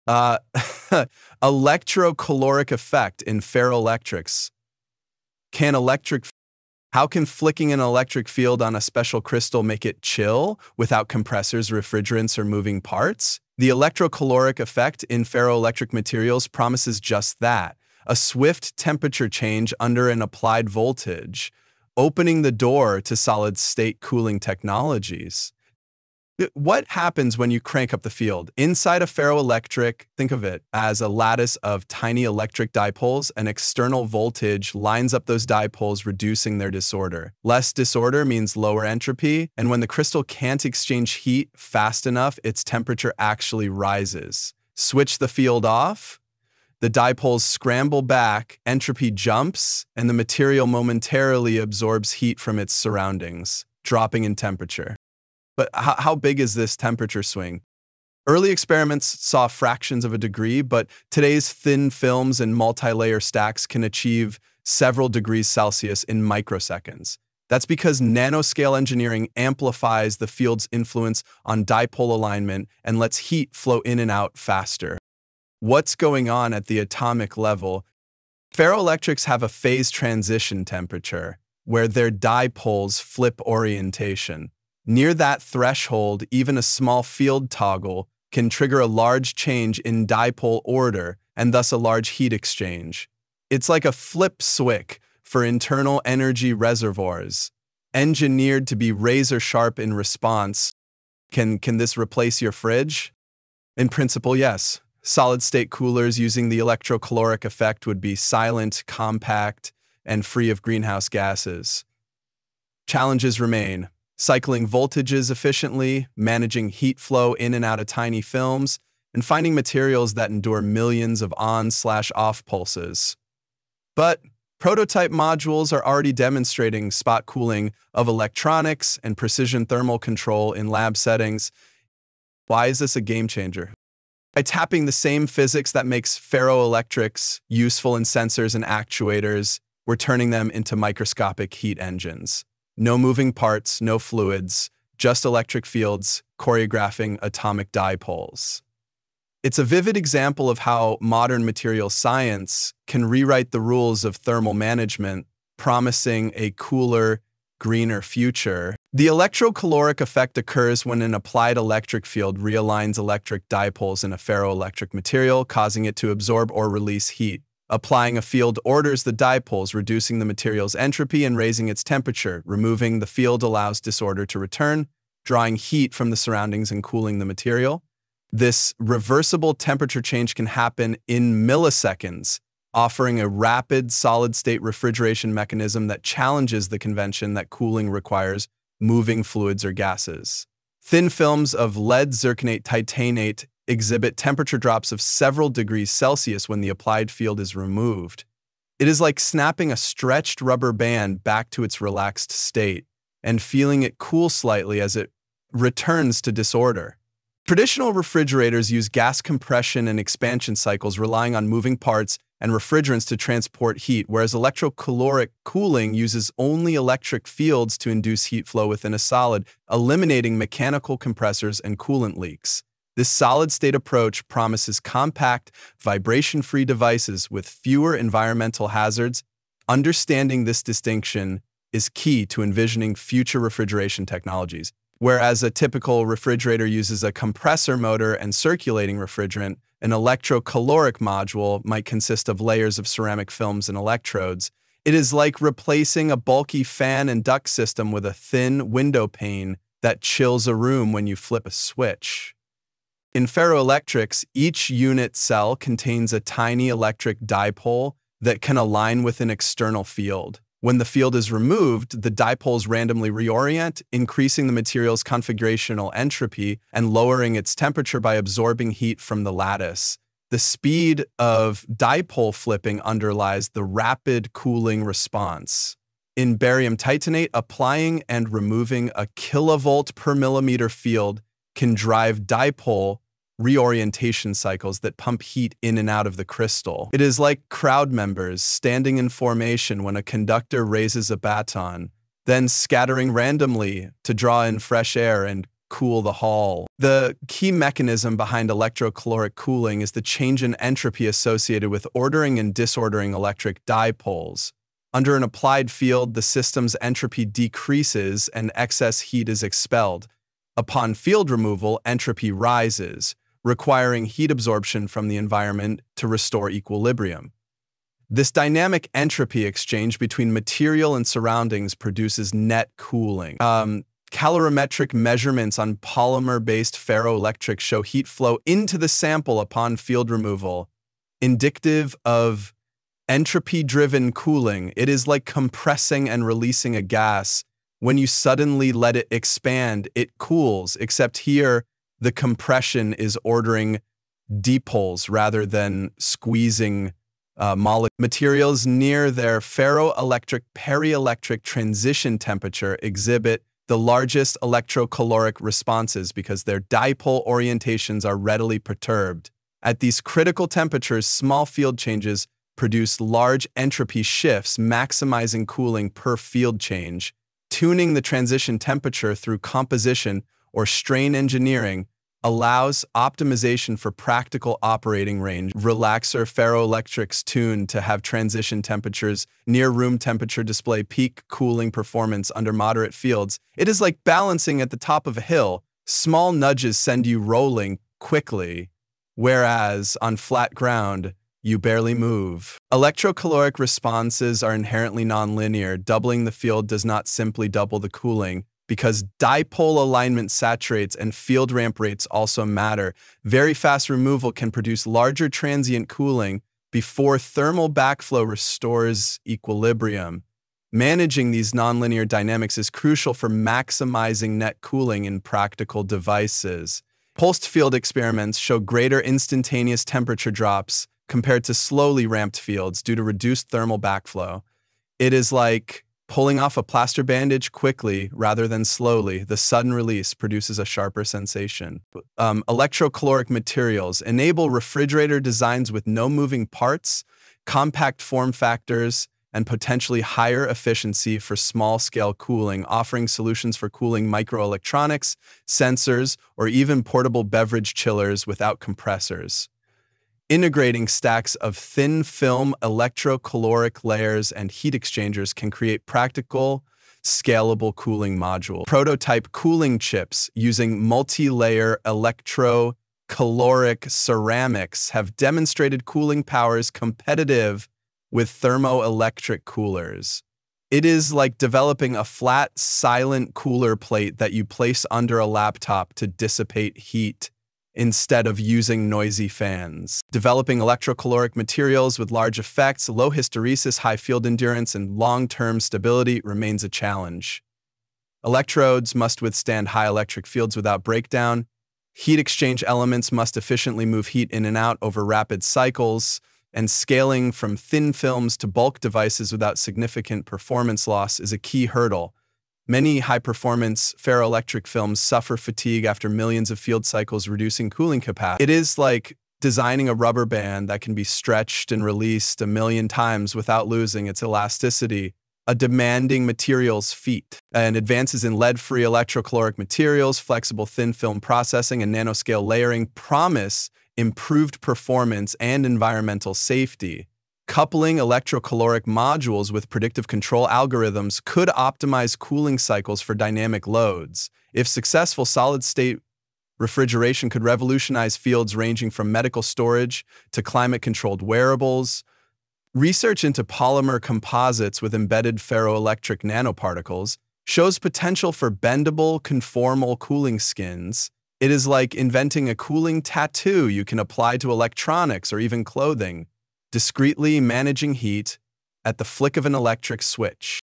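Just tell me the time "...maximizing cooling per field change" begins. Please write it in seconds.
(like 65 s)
364 s.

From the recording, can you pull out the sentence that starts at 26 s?
What happens when you crank up the field?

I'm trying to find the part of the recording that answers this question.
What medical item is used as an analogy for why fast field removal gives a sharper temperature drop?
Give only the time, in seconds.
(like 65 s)
426 s.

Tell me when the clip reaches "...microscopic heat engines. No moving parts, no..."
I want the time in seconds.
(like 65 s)
140 s.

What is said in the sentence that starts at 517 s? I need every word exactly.
And advances in lead-free electrocaloric materials, flexible thin film processing, and nanoscale layering promise improved performance and environmental safety.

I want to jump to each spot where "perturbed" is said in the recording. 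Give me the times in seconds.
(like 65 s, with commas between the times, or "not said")
358 s.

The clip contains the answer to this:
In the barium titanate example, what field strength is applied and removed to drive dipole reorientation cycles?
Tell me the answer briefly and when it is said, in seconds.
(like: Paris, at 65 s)
1 kilovolt per millimeter, at 278 s.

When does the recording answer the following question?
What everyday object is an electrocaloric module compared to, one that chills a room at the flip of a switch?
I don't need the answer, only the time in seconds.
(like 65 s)
248 s.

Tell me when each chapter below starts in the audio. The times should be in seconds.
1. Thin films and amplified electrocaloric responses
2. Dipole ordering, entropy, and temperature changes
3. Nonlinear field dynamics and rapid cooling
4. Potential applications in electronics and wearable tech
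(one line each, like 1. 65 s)
1. 186 s
2. 93 s
3. 310 s
4. 469 s.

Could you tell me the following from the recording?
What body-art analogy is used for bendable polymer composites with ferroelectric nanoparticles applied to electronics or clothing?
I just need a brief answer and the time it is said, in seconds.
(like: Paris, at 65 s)
a cooling tattoo, at 552 s.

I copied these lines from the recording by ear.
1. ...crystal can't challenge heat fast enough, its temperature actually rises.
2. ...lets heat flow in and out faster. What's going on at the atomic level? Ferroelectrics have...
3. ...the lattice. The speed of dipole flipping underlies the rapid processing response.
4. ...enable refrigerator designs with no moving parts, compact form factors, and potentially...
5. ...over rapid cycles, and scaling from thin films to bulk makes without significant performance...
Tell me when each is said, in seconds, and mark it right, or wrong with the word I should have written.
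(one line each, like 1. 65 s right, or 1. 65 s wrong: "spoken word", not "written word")
1. 39 s wrong: "exchange", not "challenge"
2. 72 s right
3. 269 s wrong: "cooling", not "processing"
4. 434 s right
5. 494 s wrong: "devices", not "makes".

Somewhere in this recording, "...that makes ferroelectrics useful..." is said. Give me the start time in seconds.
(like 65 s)
135 s.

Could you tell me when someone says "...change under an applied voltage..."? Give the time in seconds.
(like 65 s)
19 s.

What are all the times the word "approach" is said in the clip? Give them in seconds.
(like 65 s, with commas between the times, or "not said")
223 s.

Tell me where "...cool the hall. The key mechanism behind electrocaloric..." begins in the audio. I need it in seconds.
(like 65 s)
295 s.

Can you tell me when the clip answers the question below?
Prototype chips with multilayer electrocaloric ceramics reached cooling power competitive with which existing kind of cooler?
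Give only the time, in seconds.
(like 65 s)
468 s.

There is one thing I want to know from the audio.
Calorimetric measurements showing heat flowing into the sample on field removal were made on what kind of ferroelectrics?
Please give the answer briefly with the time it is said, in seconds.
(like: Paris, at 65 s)
polymer-based ferroelectrics, at 325 s.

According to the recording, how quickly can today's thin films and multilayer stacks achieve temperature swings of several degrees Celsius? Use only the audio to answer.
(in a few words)
microseconds.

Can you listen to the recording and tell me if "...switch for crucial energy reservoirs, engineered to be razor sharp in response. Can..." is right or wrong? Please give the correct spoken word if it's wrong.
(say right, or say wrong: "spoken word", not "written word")
wrong: "internal", not "crucial".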